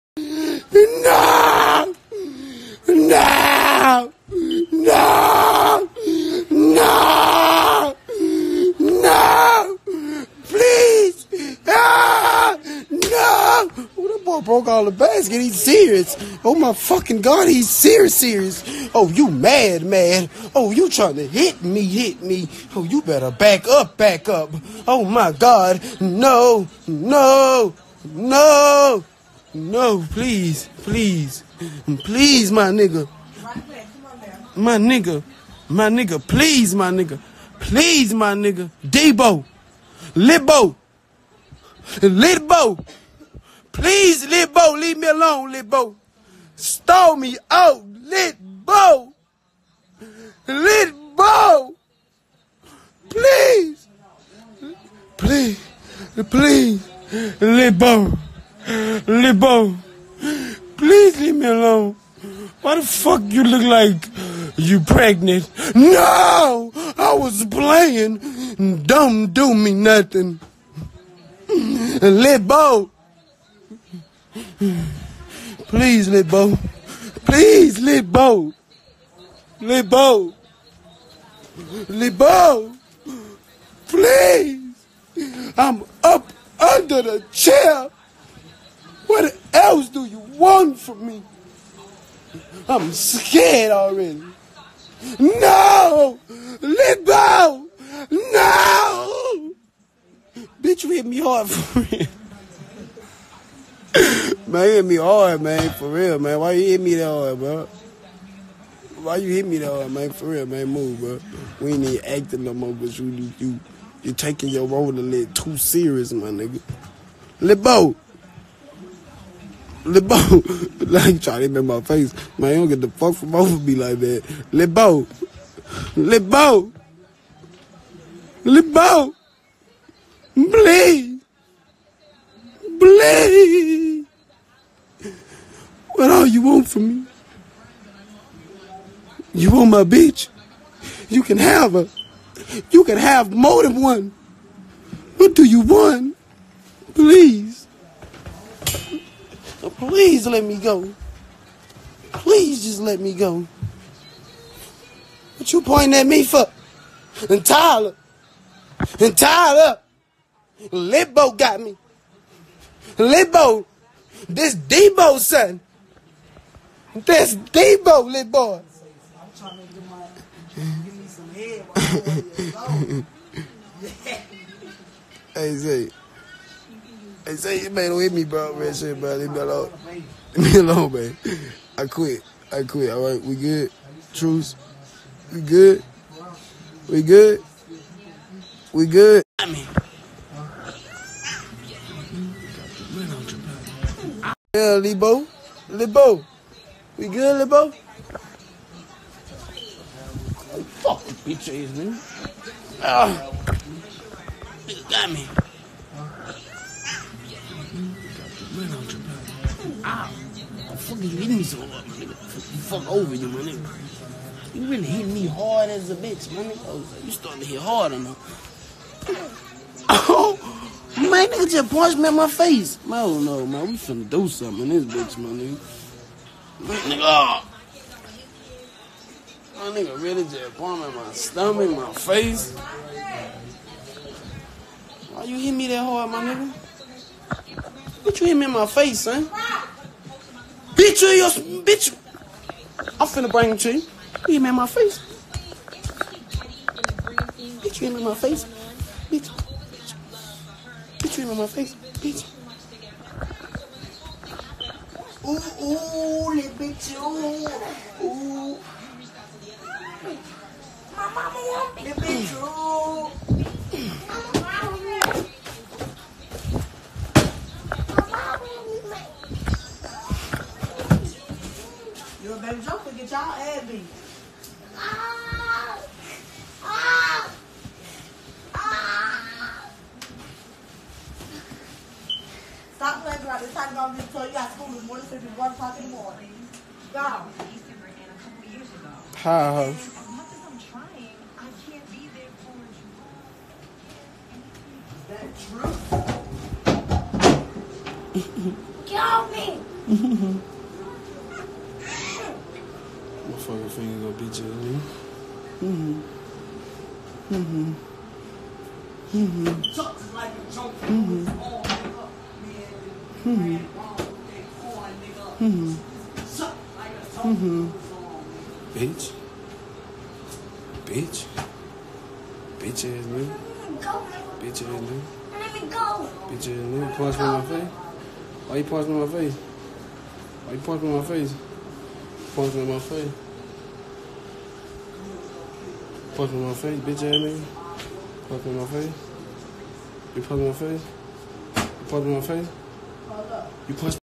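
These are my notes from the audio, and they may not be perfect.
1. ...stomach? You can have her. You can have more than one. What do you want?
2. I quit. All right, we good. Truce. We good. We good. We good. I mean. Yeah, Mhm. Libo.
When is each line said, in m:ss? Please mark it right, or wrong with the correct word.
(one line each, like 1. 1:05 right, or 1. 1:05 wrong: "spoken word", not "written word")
1. 2:19 wrong: "bitch", not "stomach"
2. 3:02 wrong: "Libo", not "Mhm".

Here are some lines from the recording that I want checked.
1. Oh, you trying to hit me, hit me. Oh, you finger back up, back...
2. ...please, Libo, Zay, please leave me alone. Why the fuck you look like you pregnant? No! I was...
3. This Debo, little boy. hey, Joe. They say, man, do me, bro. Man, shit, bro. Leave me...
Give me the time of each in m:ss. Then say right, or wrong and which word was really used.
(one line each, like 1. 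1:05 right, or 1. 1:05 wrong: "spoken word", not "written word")
1. 0:20 wrong: "better", not "finger"
2. 0:56 wrong: "Libo", not "Zay"
3. 2:46 wrong: "Zay", not "Joe".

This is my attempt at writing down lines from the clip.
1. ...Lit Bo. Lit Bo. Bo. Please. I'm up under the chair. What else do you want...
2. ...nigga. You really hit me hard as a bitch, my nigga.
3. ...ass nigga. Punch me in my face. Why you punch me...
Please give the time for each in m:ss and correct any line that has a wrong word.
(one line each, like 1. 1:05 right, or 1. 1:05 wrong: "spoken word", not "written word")
1. 1:17 right
2. 3:33 right
3. 5:26 right.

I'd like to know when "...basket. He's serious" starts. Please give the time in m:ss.
0:14.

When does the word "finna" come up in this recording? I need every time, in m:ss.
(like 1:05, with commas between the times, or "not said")
3:43, 4:03.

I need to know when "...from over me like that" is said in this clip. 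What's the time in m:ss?
2:03.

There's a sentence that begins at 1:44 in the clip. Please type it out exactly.
man, you hit me hard, man, for real, man.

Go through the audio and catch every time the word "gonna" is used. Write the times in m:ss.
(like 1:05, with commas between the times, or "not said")
5:03.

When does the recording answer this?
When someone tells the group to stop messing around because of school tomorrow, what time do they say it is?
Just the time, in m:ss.
4:45.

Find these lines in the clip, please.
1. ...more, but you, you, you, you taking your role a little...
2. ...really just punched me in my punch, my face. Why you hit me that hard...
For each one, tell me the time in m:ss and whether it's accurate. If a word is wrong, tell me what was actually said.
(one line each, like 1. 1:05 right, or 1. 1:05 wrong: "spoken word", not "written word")
1. 1:52 right
2. 3:50 wrong: "stomach", not "punch".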